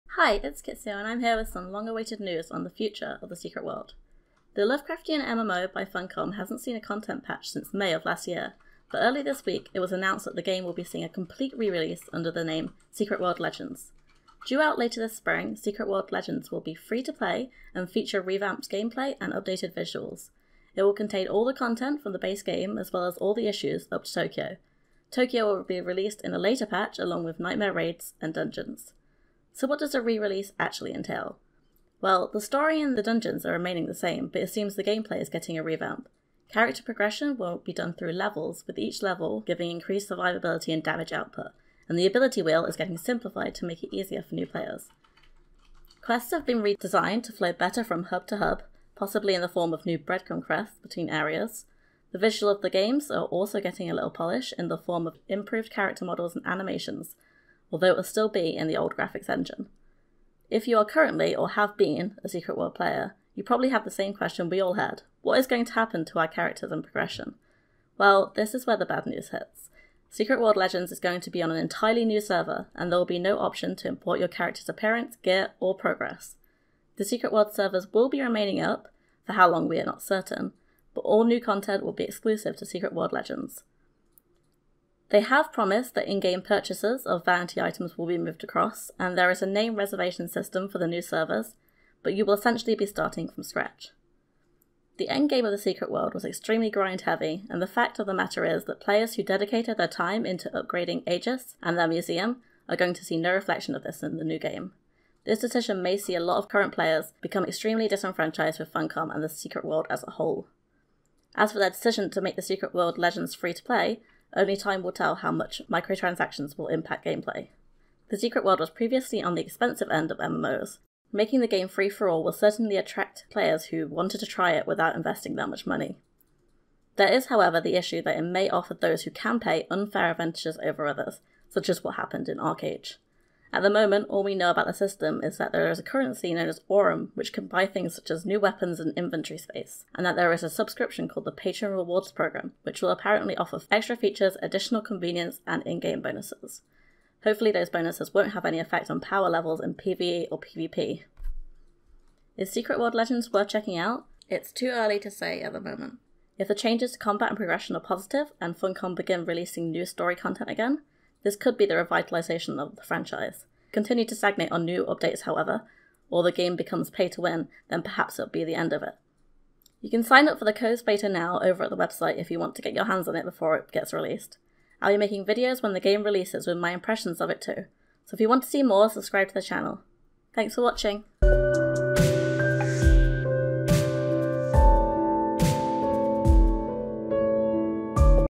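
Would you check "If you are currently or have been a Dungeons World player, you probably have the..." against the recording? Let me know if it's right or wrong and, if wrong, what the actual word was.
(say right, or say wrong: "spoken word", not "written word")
wrong: "Secret", not "Dungeons".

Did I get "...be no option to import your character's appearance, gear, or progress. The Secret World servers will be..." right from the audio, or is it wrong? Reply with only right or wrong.
right.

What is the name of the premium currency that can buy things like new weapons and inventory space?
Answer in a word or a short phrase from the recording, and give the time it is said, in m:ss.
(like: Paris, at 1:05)
Aurum, at 2:16.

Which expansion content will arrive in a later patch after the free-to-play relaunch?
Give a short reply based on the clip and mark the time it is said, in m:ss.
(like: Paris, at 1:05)
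Tokyo, at 0:25.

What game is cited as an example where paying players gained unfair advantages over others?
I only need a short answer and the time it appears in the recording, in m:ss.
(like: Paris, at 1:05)
ArcheAge, at 2:12.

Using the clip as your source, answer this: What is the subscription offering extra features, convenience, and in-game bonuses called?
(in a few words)
Patron Rewards Program.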